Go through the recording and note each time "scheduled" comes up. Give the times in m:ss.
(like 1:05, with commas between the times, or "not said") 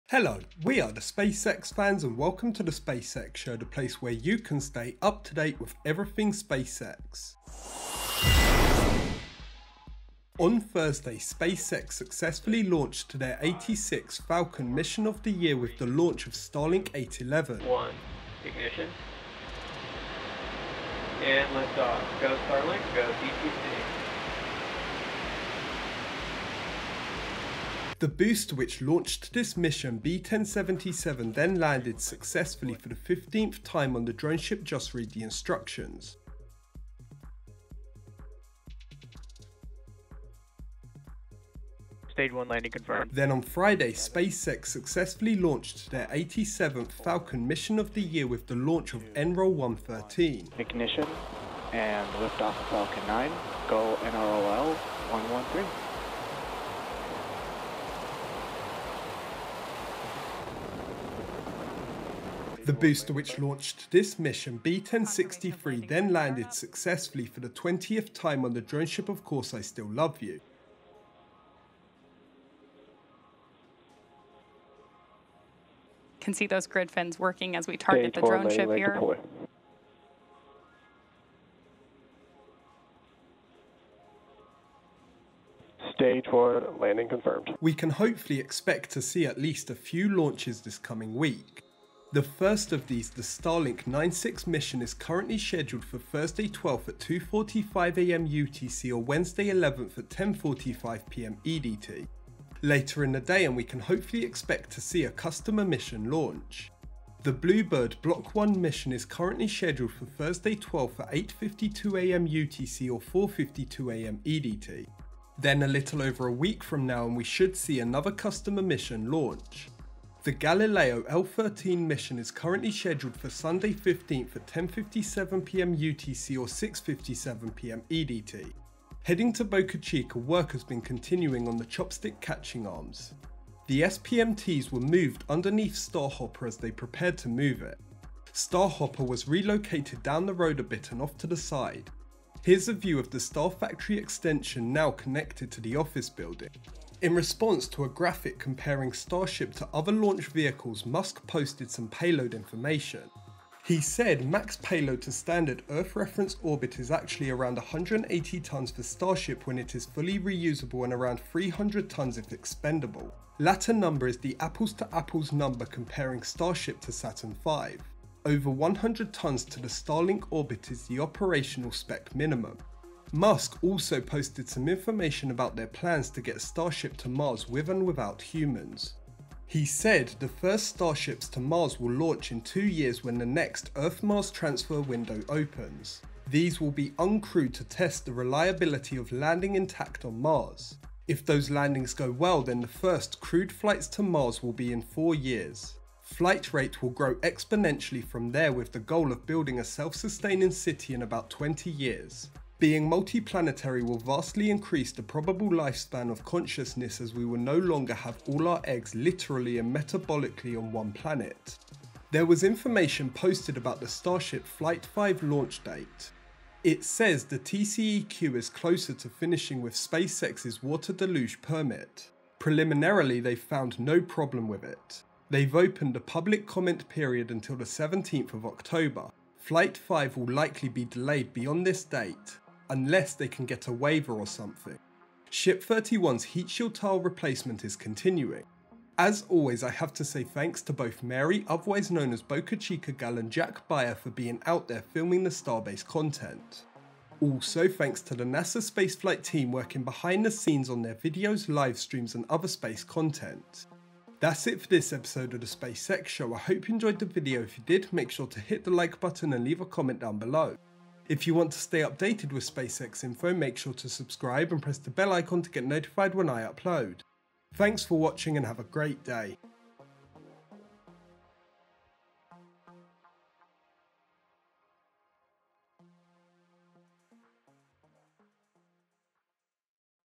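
1:35, 1:49, 2:02.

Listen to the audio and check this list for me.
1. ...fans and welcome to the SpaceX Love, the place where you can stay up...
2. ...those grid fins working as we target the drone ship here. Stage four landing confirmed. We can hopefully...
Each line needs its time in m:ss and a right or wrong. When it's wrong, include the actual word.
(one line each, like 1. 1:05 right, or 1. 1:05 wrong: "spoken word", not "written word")
1. 0:01 wrong: "Show", not "Love"
2. 1:16 right.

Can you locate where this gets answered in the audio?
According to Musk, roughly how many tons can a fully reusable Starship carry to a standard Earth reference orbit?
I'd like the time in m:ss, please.
2:37.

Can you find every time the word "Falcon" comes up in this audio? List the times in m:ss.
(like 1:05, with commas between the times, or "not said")
0:14, 0:47, 0:52.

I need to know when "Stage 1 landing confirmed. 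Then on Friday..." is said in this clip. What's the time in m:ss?
0:42.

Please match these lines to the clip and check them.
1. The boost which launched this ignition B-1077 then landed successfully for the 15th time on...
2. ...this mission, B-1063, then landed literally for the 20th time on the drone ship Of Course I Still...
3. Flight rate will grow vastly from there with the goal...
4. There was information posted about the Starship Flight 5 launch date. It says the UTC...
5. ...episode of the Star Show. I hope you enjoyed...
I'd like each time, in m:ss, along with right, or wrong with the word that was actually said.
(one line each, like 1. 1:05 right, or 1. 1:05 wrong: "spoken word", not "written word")
1. 0:28 wrong: "mission", not "ignition"
2. 1:03 wrong: "successfully", not "literally"
3. 3:16 wrong: "exponentially", not "vastly"
4. 3:32 wrong: "TCEQ", not "UTC"
5. 4:14 wrong: "SpaceX", not "Star".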